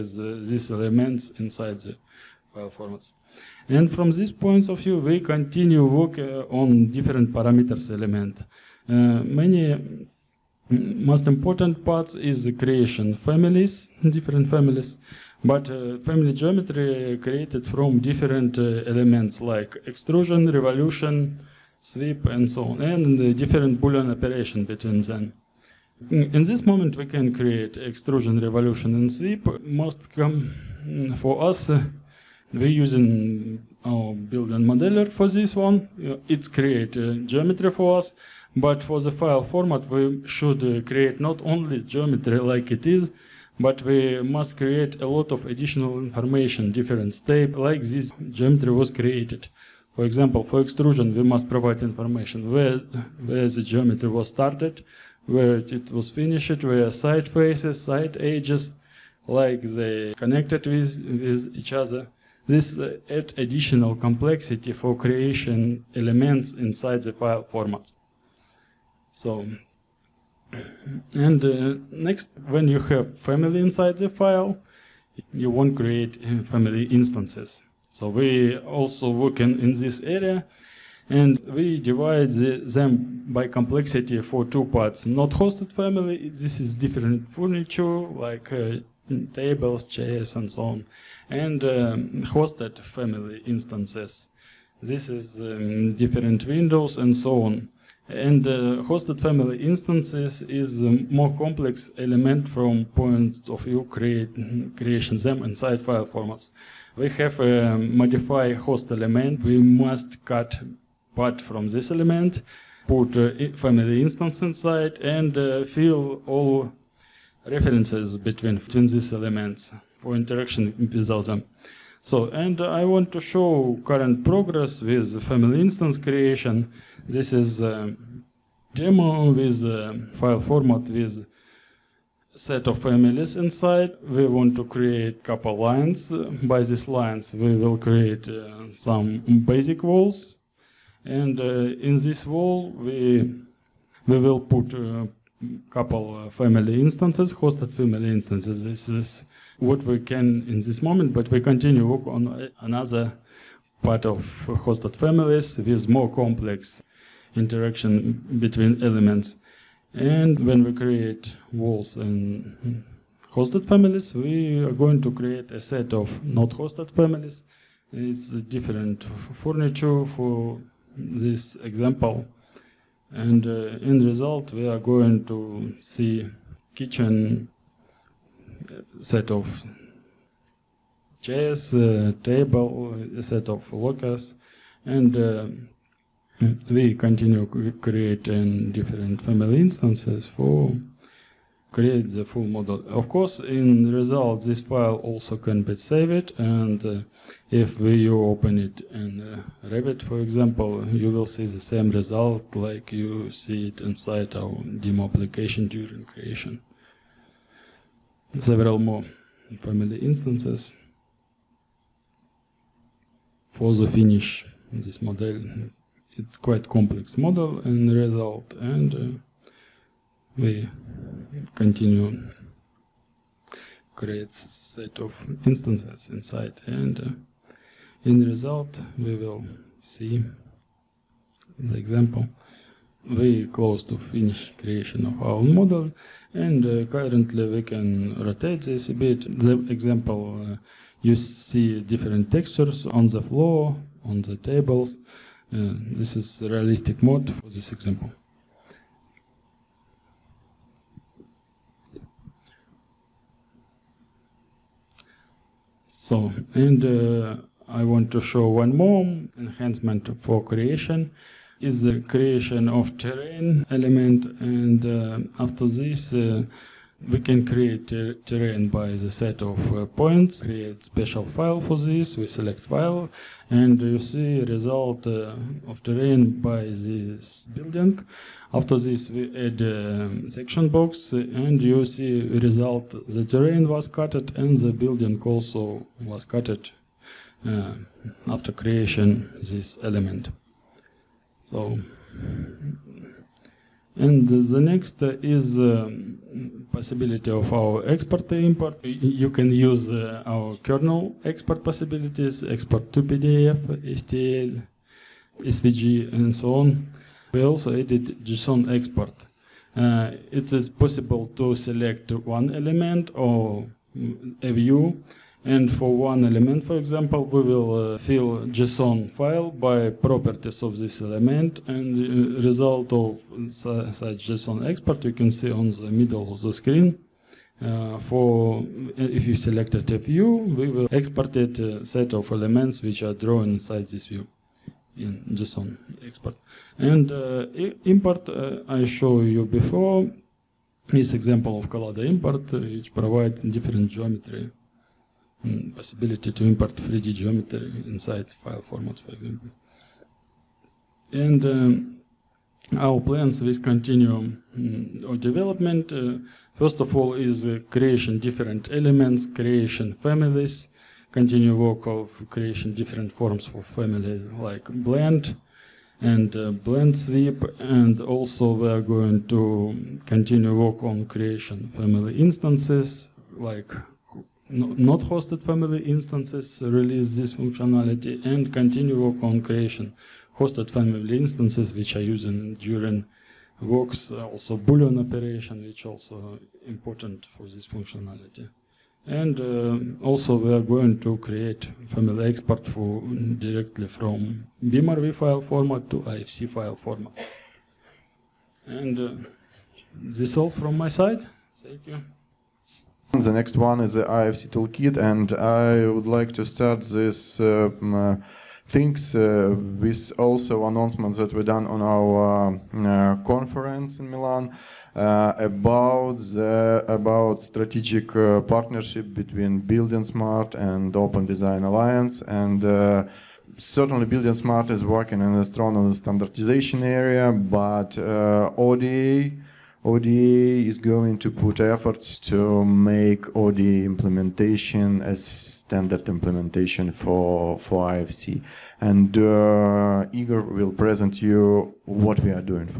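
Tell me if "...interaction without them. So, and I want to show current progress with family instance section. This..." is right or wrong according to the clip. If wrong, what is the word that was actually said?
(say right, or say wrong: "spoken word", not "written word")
wrong: "creation", not "section".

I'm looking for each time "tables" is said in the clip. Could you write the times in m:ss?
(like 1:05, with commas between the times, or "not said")
1:29, 3:02, 4:04.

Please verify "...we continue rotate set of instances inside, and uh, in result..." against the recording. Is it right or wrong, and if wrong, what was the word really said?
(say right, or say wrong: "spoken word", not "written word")
wrong: "create", not "rotate".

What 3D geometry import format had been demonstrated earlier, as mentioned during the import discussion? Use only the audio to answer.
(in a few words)
Collada.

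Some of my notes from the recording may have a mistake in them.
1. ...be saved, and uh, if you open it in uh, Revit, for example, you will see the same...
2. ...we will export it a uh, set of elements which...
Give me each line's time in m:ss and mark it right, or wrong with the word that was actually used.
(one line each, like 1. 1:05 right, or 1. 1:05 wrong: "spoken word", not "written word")
1. 3:15 right
2. 5:30 right.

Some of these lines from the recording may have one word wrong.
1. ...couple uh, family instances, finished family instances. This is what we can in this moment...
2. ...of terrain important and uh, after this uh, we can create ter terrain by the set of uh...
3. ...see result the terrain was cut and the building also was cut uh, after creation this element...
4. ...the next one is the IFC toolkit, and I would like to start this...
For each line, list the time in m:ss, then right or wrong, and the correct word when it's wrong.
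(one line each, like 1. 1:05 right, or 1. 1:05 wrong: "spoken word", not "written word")
1. 2:25 wrong: "hosted", not "finished"
2. 4:22 wrong: "element", not "important"
3. 4:41 right
4. 6:43 right.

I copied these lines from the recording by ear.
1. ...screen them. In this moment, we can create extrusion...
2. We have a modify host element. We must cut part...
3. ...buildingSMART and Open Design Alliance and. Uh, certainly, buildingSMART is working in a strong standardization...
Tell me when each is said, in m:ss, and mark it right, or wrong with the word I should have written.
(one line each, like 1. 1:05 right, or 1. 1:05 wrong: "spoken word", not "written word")
1. 0:24 wrong: "between", not "screen"
2. 1:46 right
3. 6:59 right.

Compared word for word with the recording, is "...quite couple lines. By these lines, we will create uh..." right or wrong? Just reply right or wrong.
wrong.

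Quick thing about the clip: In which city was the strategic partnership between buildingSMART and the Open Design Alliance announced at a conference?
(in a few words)
Milan.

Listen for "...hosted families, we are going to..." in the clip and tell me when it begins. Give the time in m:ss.
2:43.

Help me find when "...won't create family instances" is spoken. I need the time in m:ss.
1:15.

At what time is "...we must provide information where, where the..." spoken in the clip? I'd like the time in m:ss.
0:51.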